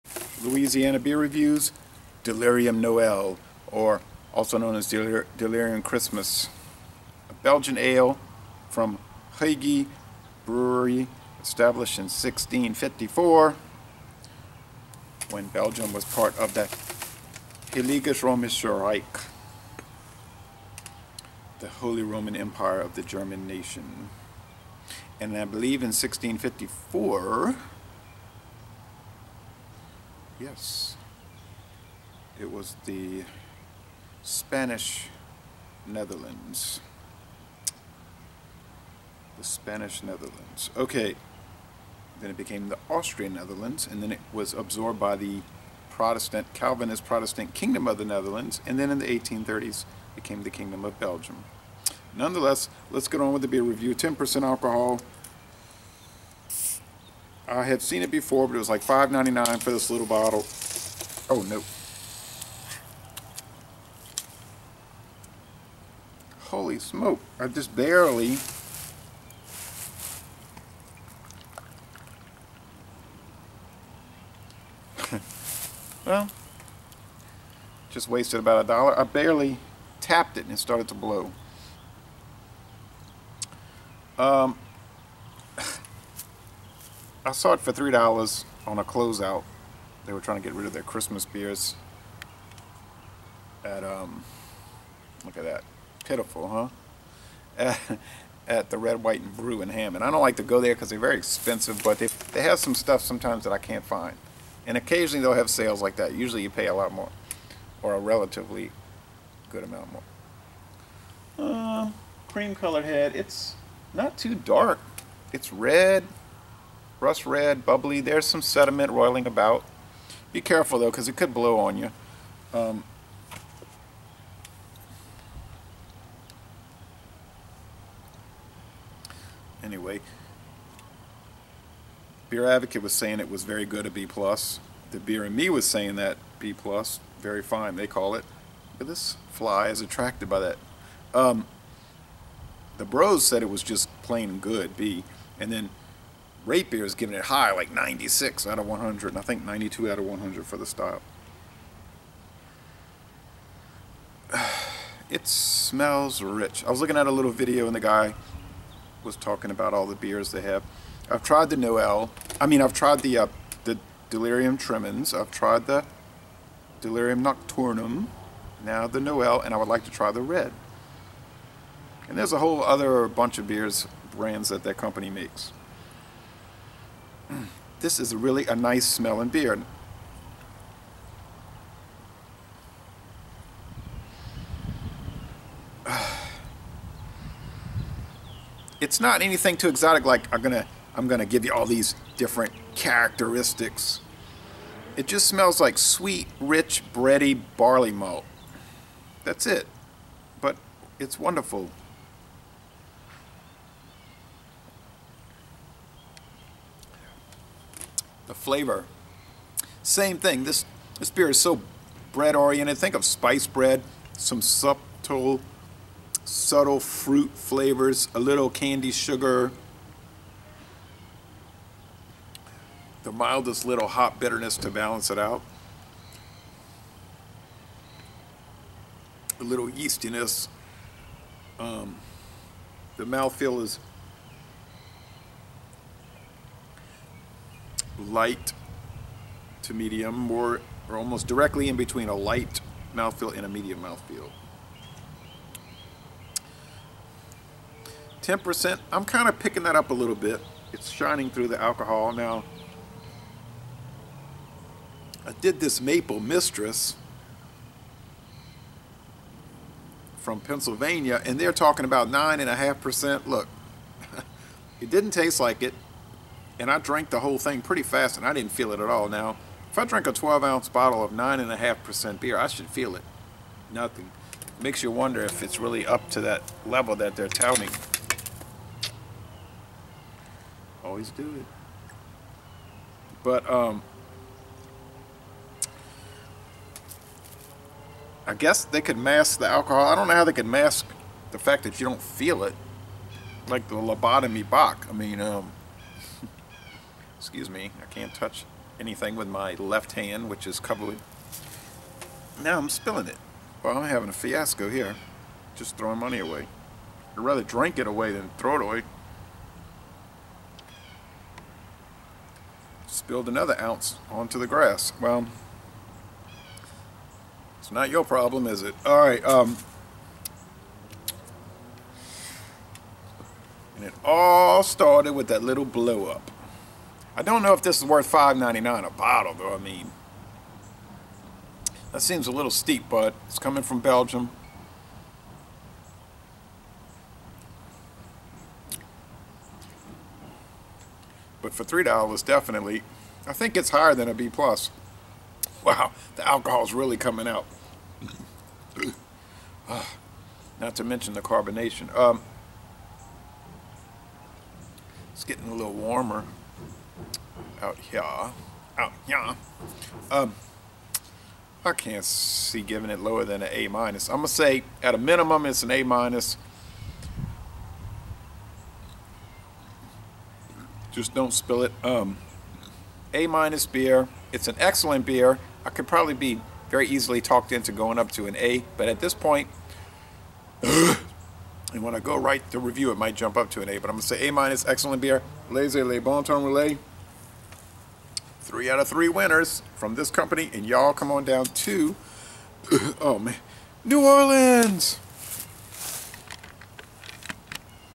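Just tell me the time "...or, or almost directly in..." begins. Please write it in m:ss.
4:00.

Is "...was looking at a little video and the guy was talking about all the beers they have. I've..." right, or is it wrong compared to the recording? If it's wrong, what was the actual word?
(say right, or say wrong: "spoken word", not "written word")
right.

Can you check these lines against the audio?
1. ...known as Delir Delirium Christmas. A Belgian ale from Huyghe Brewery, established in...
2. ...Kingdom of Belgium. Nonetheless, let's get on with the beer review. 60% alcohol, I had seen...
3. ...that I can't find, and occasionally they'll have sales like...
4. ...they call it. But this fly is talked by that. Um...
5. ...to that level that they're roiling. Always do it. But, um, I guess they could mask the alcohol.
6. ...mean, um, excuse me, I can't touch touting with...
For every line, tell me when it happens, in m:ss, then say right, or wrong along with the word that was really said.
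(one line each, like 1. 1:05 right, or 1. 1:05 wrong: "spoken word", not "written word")
1. 0:04 right
2. 0:50 wrong: "10", not "60"
3. 1:43 right
4. 2:17 wrong: "attracted", not "talked"
5. 4:36 wrong: "touting", not "roiling"
6. 4:54 wrong: "anything", not "touting".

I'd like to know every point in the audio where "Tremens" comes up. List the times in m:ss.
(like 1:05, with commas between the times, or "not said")
2:44.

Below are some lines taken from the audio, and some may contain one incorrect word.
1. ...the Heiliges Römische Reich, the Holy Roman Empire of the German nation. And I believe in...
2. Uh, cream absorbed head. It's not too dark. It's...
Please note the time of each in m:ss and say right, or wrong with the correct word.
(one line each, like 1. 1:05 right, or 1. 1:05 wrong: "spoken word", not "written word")
1. 0:16 right
2. 1:51 wrong: "colored", not "absorbed".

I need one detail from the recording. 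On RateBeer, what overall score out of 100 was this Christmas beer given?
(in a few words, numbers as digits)
96.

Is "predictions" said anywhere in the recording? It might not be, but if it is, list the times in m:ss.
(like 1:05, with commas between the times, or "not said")
not said.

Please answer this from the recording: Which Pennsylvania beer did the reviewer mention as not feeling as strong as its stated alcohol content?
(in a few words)
Maple Mistress.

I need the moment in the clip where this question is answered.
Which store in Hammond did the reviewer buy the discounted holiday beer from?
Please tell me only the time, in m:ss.
1:38.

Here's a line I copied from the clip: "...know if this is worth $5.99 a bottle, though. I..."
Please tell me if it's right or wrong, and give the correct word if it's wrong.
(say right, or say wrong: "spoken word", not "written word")
right.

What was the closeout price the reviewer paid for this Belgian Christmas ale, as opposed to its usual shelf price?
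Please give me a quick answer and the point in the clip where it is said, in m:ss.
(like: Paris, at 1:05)
$3, at 1:27.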